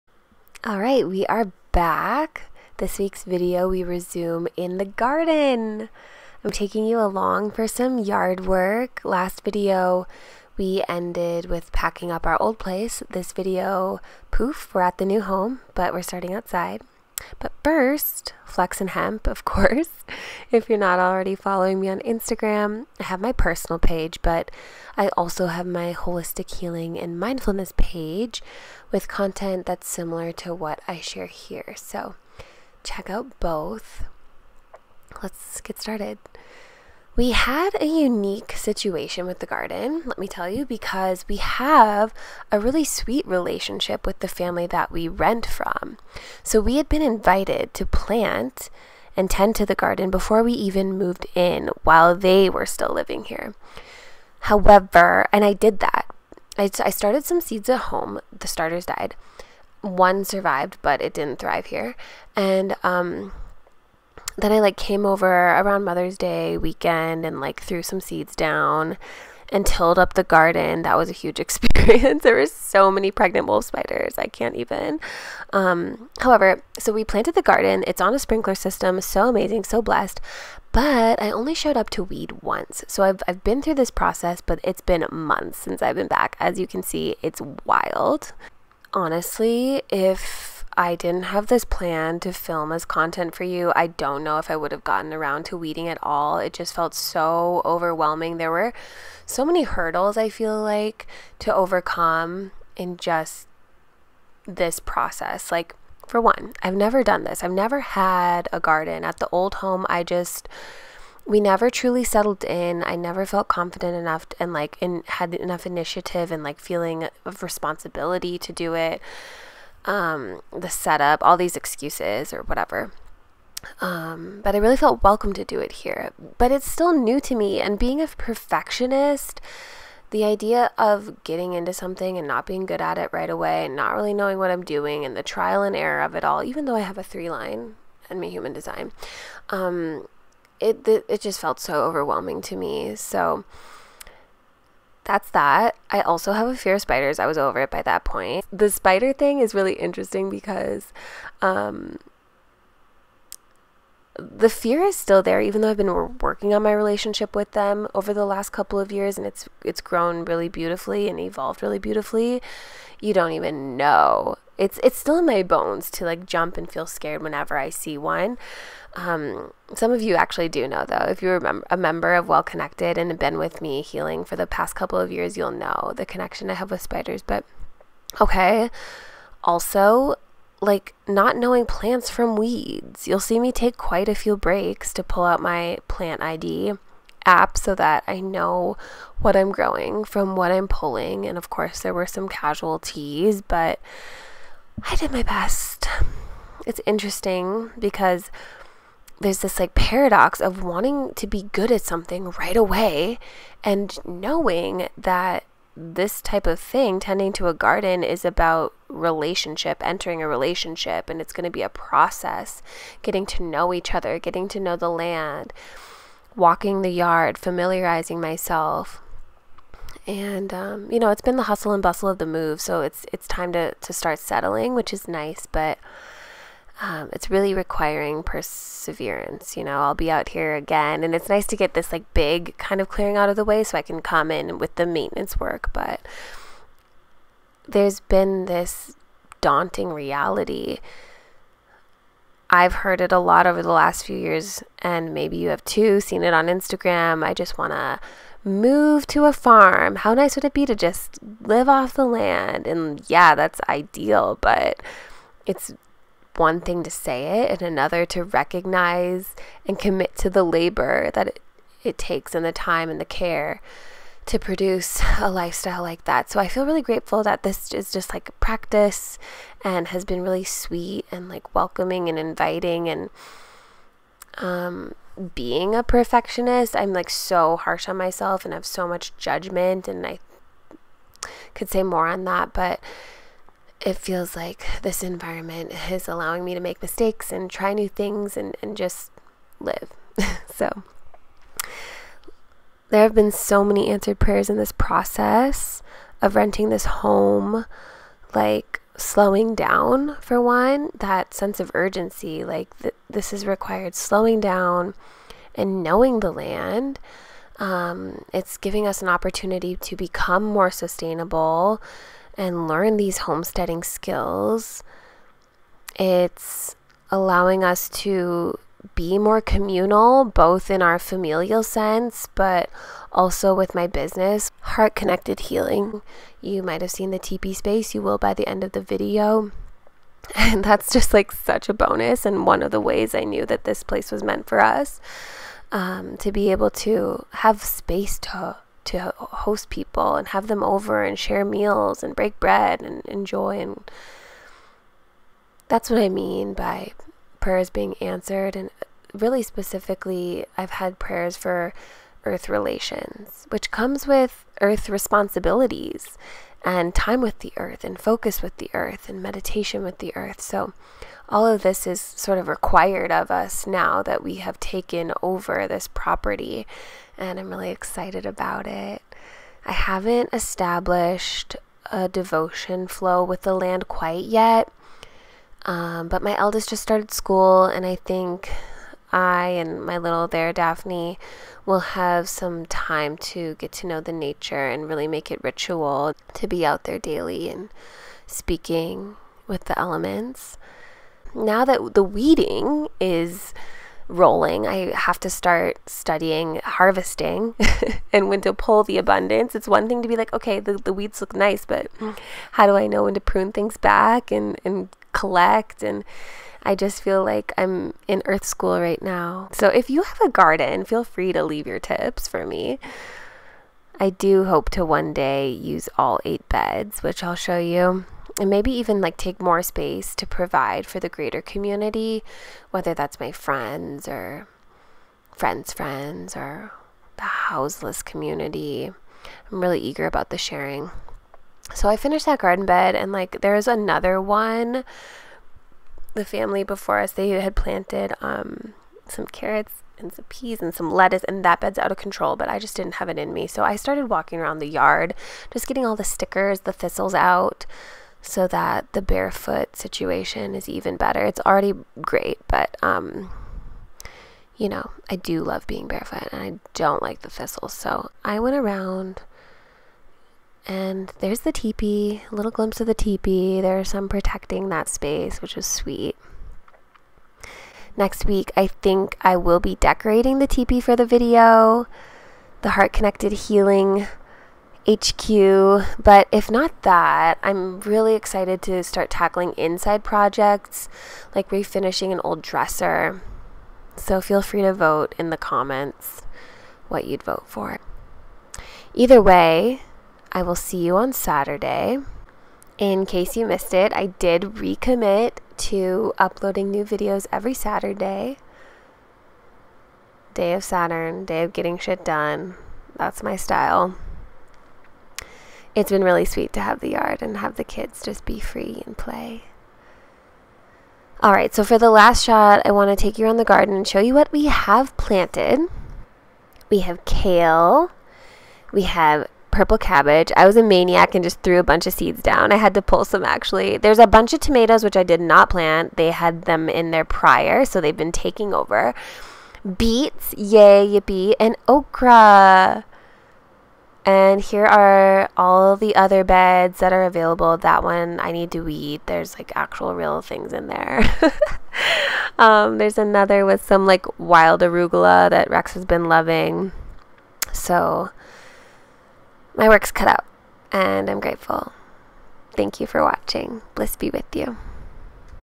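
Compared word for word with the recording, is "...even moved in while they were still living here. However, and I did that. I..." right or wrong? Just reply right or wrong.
right.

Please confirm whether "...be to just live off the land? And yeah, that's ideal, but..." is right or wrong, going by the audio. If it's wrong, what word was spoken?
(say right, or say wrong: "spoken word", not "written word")
right.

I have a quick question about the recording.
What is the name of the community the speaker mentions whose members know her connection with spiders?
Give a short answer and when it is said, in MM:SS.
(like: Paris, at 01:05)
Well Connected, at 02:52.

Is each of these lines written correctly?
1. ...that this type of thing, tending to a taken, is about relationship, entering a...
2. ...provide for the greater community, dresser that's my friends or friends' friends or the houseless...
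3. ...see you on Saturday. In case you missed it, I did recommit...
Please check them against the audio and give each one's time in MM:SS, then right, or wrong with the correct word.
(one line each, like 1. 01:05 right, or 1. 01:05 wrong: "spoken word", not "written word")
1. 03:24 wrong: "garden", not "taken"
2. 07:00 wrong: "whether", not "dresser"
3. 08:10 right.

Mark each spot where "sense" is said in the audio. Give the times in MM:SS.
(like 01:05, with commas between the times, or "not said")
05:01, 05:21.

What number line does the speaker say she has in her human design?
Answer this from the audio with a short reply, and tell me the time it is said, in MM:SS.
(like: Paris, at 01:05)
3, at 02:17.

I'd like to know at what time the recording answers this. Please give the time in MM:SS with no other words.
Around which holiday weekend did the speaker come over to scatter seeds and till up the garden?
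01:05.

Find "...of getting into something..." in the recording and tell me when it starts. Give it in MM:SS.
02:10.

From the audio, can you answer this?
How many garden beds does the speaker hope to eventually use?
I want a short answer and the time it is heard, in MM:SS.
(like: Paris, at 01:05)
8, at 06:56.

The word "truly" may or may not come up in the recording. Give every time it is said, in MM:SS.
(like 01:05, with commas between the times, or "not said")
01:51.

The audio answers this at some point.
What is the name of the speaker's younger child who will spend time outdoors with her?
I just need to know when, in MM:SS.
06:20.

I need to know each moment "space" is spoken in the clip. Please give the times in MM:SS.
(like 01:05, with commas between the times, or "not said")
05:27, 05:37, 06:59, 07:44.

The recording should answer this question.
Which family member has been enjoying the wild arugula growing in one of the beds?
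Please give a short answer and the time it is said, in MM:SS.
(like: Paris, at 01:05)
Rex, at 09:05.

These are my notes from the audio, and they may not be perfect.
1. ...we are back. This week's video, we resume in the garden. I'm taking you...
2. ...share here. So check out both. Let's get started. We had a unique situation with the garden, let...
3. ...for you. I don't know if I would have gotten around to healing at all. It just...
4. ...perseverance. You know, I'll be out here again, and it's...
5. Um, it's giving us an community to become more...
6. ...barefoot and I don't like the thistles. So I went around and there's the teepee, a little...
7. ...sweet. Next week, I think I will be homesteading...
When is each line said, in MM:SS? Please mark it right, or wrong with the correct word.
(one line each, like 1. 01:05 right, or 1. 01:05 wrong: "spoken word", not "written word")
1. 00:01 right
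2. 00:30 right
3. 01:33 wrong: "weeding", not "healing"
4. 03:48 right
5. 05:07 wrong: "opportunity", not "community"
6. 07:35 right
7. 07:45 wrong: "decorating", not "homesteading".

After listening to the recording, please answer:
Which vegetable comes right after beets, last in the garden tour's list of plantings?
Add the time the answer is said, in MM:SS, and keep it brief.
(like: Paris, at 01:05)
Okra, at 08:51.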